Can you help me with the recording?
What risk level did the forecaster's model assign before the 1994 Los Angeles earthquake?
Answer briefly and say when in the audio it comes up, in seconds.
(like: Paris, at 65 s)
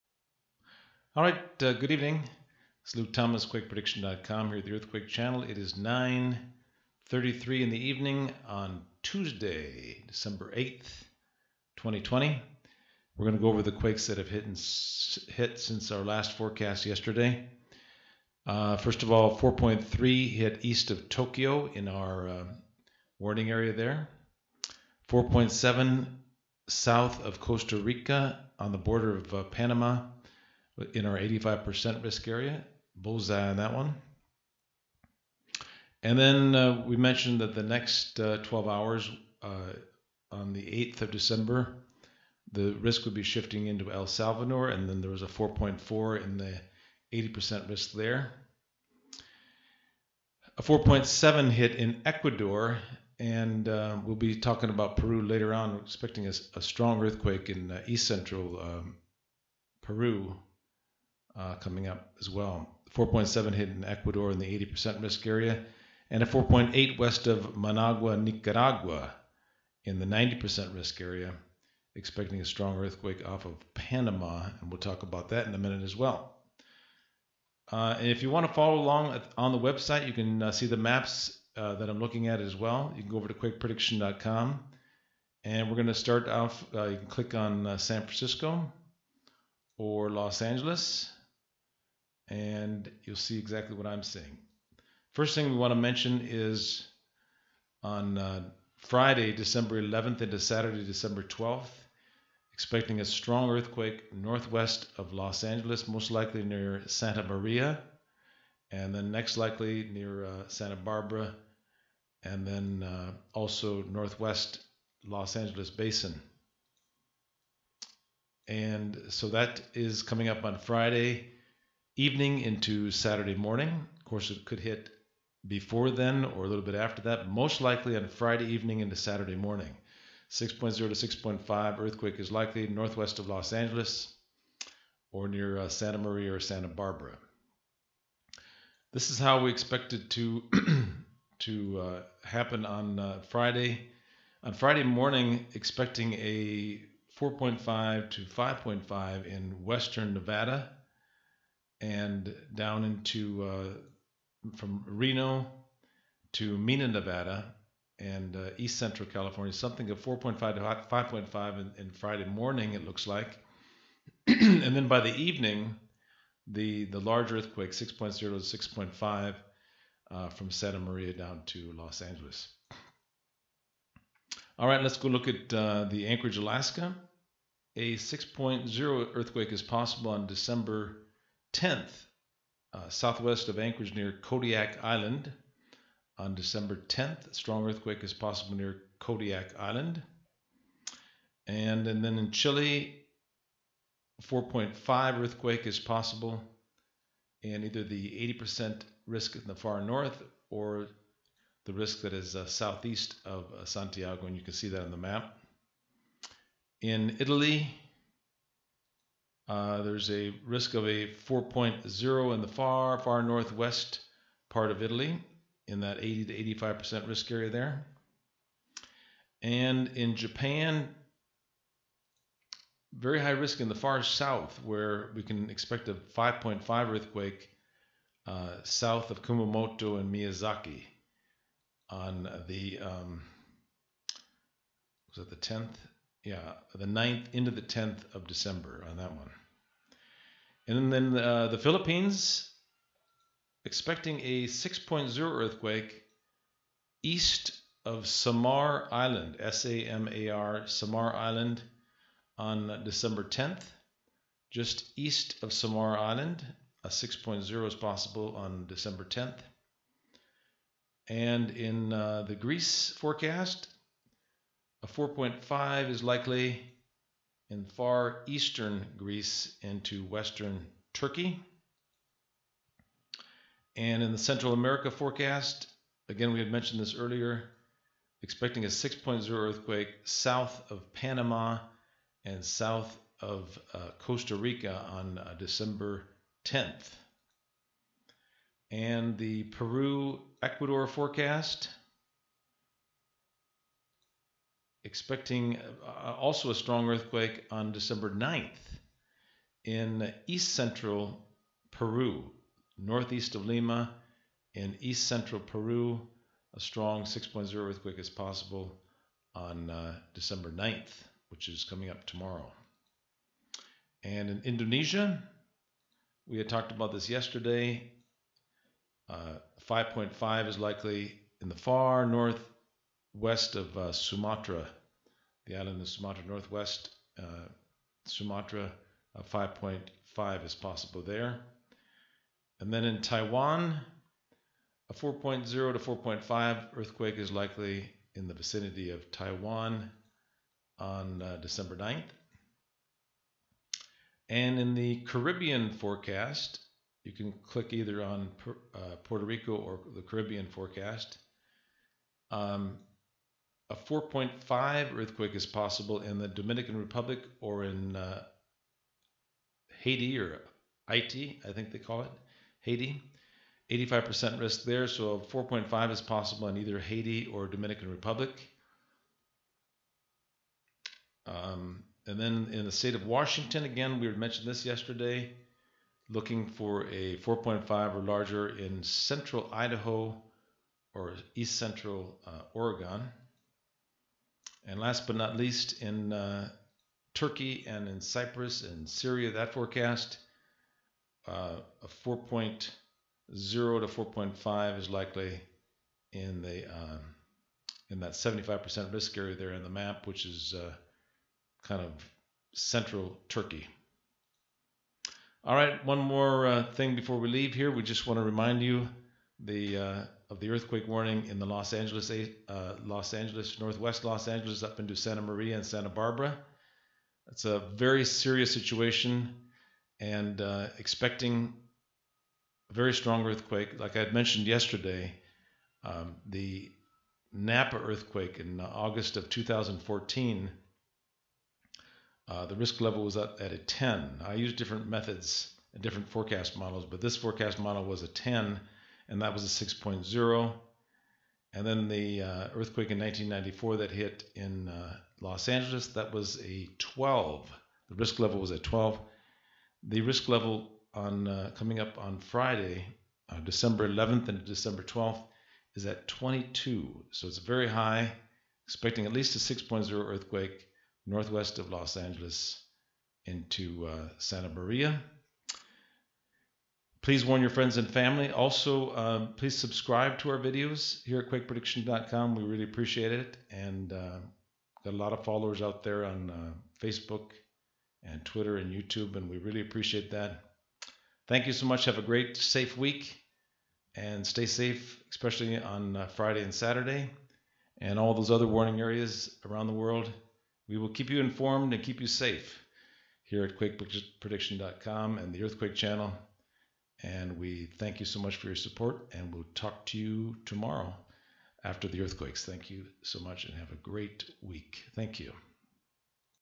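12, at 445 s.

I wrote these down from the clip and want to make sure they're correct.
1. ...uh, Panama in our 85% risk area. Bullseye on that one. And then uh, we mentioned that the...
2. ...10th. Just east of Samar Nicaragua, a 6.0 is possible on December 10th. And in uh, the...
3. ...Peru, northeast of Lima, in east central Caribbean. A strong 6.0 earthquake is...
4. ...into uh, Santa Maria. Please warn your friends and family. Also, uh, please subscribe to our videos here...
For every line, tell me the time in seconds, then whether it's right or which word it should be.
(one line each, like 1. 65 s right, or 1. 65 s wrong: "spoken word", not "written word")
1. 29 s right
2. 253 s wrong: "Island", not "Nicaragua"
3. 301 s wrong: "Peru", not "Caribbean"
4. 463 s right.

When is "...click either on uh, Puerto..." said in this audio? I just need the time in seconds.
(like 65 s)
347 s.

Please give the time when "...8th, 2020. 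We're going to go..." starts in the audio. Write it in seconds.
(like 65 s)
10 s.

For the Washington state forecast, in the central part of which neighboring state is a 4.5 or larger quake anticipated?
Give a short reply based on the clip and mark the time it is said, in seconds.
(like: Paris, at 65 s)
Idaho, at 378 s.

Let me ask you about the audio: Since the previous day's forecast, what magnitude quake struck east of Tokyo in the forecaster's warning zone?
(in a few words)
4.3.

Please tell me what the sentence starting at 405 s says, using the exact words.
All right, one more uh, thing before we leave here.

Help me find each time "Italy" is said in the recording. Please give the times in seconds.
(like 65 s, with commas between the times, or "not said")
207 s, 214 s.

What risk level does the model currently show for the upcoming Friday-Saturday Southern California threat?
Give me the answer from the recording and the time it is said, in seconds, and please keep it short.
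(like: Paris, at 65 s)
22, at 455 s.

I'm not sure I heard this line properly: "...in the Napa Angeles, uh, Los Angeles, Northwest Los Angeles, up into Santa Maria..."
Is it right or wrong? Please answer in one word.
wrong.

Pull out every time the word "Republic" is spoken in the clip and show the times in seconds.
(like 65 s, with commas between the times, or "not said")
356 s, 367 s.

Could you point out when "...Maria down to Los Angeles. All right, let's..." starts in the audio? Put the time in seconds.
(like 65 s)
170 s.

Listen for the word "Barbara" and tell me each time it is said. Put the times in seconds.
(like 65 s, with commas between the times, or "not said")
110 s, 136 s, 415 s.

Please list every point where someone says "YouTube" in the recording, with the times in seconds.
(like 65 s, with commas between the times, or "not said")
478 s.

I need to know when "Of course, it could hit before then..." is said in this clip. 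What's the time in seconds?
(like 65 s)
123 s.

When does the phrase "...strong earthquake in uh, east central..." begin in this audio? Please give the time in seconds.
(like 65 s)
56 s.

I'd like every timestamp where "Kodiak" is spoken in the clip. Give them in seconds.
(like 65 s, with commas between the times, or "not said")
184 s, 188 s.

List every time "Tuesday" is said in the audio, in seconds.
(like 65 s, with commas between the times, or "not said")
9 s.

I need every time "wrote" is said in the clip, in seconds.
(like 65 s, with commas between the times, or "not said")
not said.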